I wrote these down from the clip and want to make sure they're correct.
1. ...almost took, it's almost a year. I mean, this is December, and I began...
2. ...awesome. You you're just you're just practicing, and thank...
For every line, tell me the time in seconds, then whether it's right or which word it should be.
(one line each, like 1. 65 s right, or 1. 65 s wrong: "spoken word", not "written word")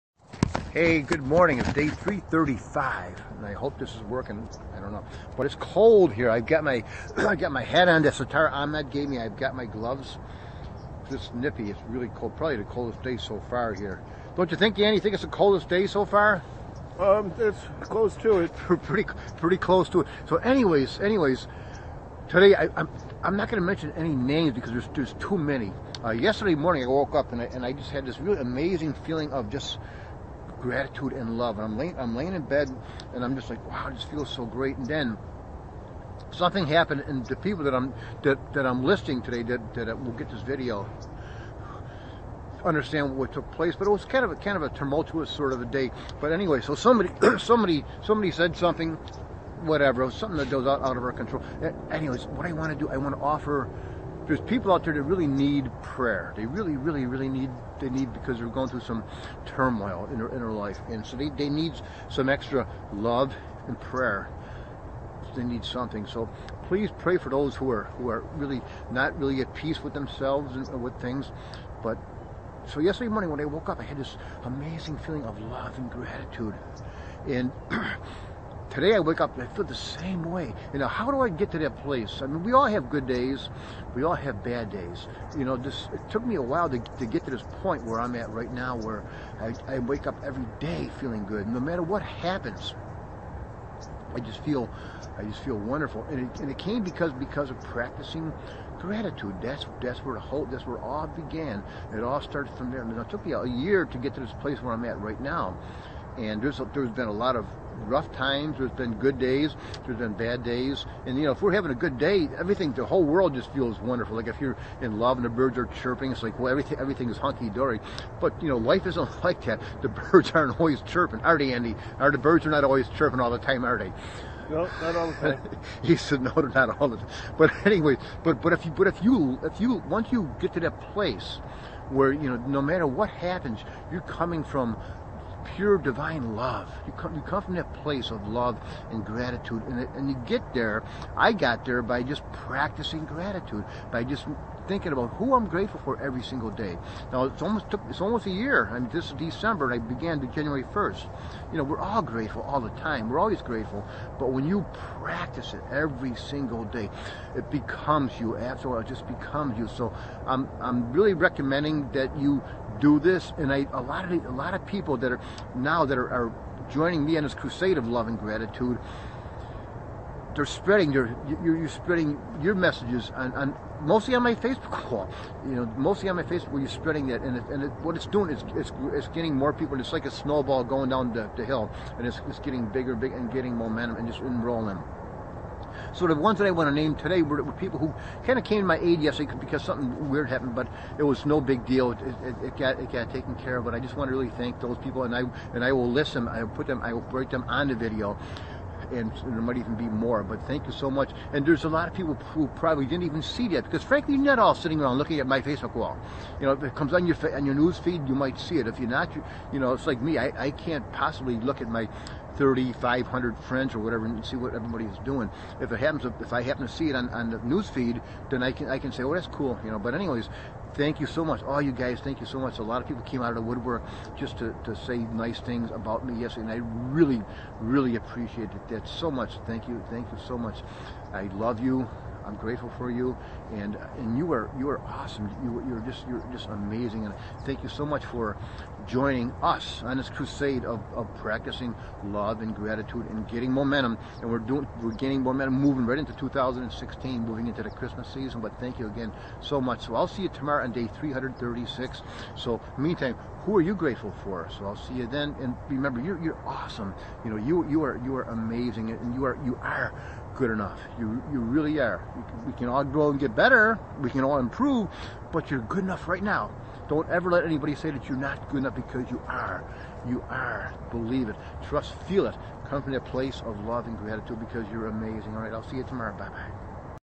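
1. 147 s right
2. 234 s wrong: "amazing", not "practicing".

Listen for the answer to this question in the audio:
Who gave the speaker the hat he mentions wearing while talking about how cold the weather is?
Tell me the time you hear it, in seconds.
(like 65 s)
8 s.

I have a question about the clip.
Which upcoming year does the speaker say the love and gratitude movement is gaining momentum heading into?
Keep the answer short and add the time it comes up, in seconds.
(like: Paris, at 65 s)
2016, at 246 s.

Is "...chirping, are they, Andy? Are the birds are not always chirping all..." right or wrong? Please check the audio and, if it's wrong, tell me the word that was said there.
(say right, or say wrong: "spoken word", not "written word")
right.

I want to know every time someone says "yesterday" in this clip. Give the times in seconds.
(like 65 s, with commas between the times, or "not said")
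26 s, 72 s, 189 s, 226 s.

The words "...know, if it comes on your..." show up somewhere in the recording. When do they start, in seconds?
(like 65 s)
206 s.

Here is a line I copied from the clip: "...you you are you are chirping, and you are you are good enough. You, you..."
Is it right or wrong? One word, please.
wrong.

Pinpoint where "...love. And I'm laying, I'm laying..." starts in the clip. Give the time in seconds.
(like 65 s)
31 s.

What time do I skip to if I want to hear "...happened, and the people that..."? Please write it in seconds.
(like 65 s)
36 s.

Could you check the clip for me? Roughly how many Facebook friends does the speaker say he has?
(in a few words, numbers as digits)
3,500.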